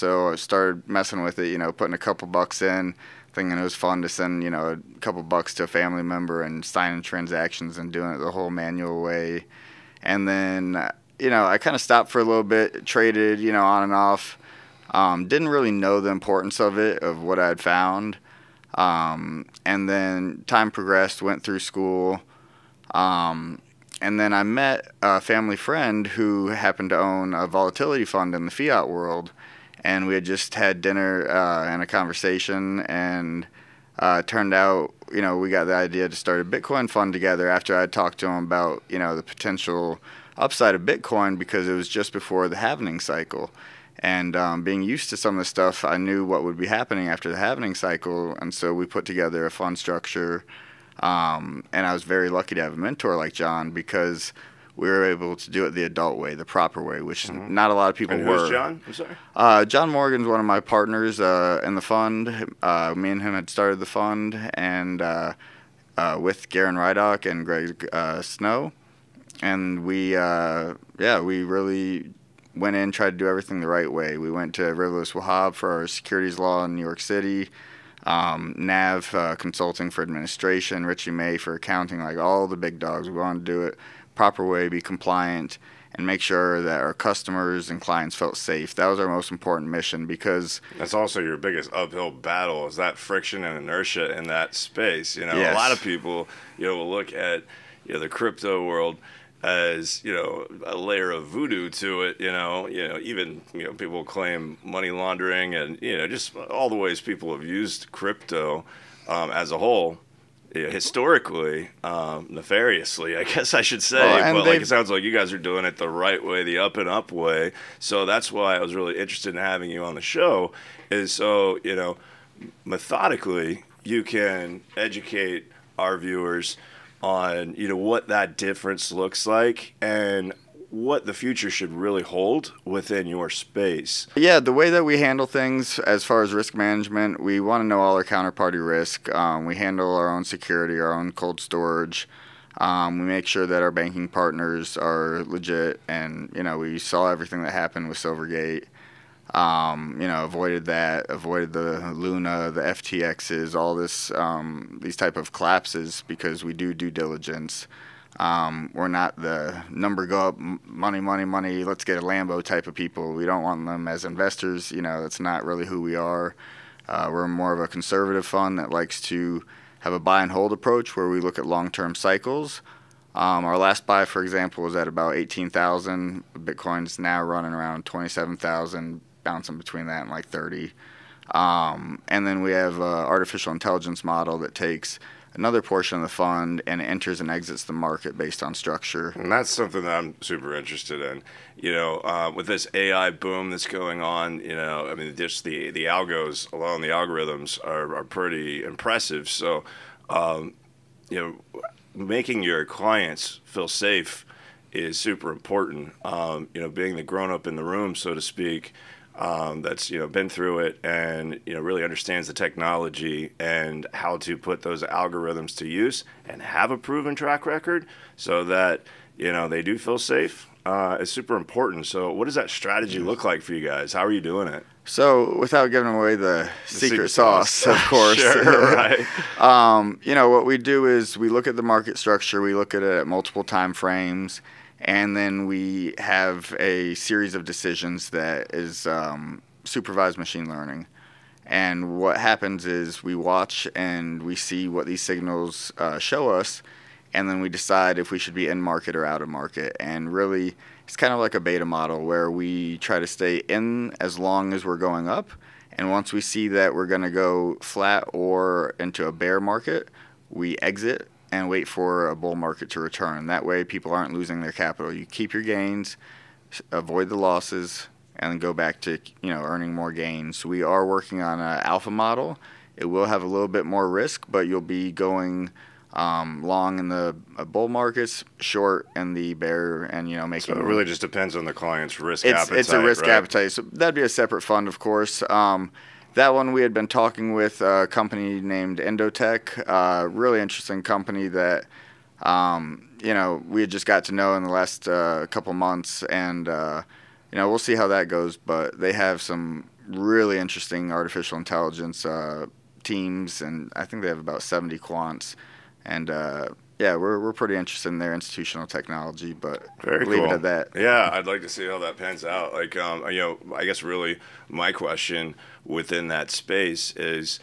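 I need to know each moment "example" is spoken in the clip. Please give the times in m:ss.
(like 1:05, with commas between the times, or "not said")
2:54.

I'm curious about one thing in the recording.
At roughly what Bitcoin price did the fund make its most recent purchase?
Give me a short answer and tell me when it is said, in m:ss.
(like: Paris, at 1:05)
18,000, at 2:55.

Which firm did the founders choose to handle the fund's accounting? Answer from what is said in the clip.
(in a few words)
Richey May.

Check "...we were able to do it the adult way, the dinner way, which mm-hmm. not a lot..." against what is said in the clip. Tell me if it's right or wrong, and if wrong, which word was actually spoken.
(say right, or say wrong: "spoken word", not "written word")
wrong: "proper", not "dinner".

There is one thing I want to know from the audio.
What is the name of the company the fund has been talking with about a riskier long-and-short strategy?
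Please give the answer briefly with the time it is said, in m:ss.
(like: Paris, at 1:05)
Endotech, at 4:48.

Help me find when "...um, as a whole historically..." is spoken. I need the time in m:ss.
1:49.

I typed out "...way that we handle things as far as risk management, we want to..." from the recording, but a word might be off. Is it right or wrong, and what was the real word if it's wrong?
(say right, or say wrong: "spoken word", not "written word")
right.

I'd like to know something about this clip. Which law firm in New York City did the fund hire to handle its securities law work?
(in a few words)
Riverless Wahab.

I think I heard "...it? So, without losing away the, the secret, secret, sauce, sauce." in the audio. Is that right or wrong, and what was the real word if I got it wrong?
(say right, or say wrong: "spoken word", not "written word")
wrong: "giving", not "losing".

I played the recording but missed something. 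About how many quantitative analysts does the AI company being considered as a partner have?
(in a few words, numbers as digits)
70.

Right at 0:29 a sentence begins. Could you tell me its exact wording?
And we had just had dinner uh, and a conversation.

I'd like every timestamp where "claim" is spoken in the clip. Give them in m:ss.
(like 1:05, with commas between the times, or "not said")
1:44.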